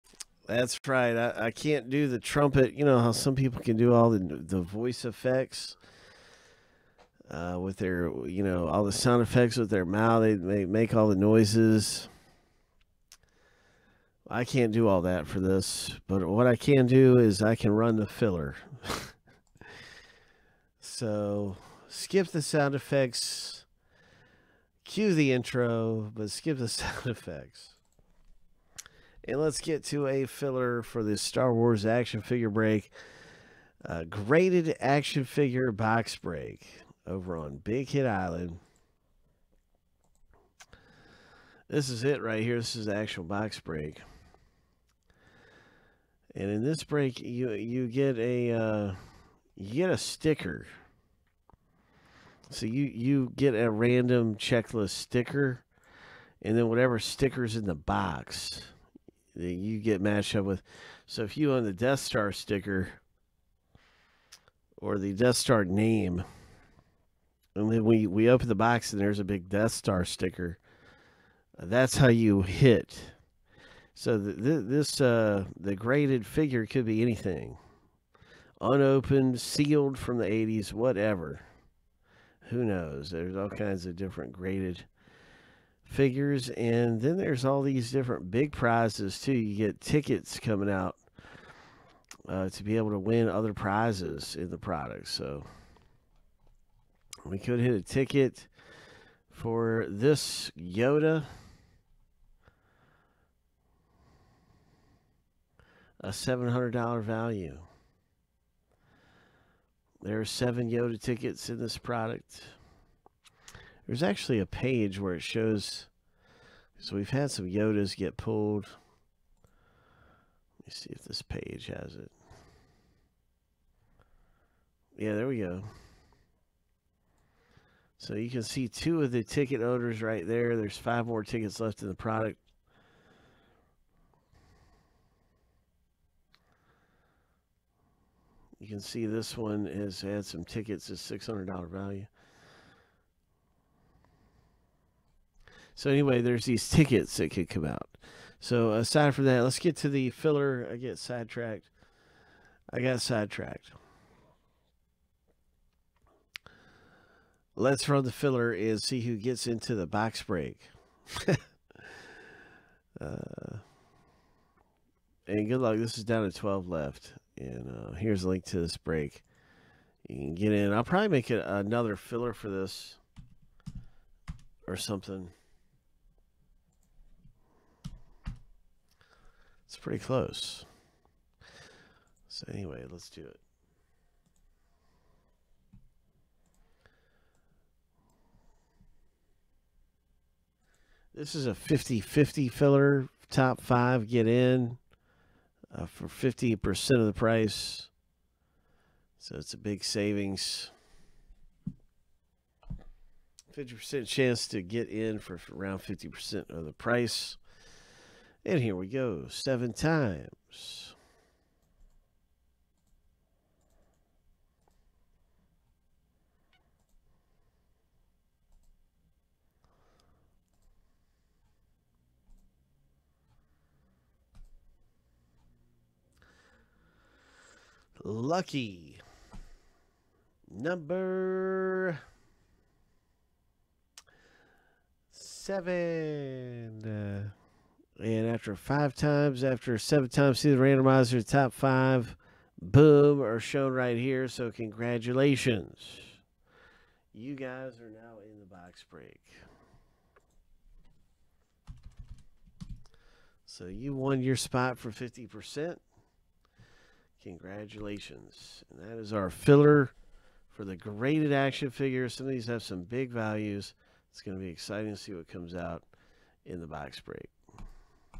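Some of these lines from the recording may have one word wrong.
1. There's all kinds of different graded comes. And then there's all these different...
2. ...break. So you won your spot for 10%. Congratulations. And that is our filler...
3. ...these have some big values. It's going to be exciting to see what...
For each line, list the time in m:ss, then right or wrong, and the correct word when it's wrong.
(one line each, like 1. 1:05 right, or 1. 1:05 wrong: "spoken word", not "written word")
1. 1:23 wrong: "figures", not "comes"
2. 4:08 wrong: "50", not "10"
3. 4:22 right.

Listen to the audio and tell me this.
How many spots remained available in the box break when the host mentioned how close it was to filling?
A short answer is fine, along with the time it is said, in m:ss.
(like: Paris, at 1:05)
12, at 2:46.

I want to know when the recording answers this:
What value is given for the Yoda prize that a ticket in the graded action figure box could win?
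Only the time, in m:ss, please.
1:46.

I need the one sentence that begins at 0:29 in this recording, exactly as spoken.
And let's get to a filler for this Star Wars action figure break.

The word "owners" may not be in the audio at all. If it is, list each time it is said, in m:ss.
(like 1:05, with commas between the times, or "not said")
2:09.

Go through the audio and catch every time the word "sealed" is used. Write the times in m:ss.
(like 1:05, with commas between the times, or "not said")
1:19.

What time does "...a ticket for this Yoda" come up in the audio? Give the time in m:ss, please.
1:37.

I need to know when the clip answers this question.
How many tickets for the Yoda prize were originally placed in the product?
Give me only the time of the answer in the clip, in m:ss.
1:50.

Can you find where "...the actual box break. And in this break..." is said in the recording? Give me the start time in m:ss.
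0:42.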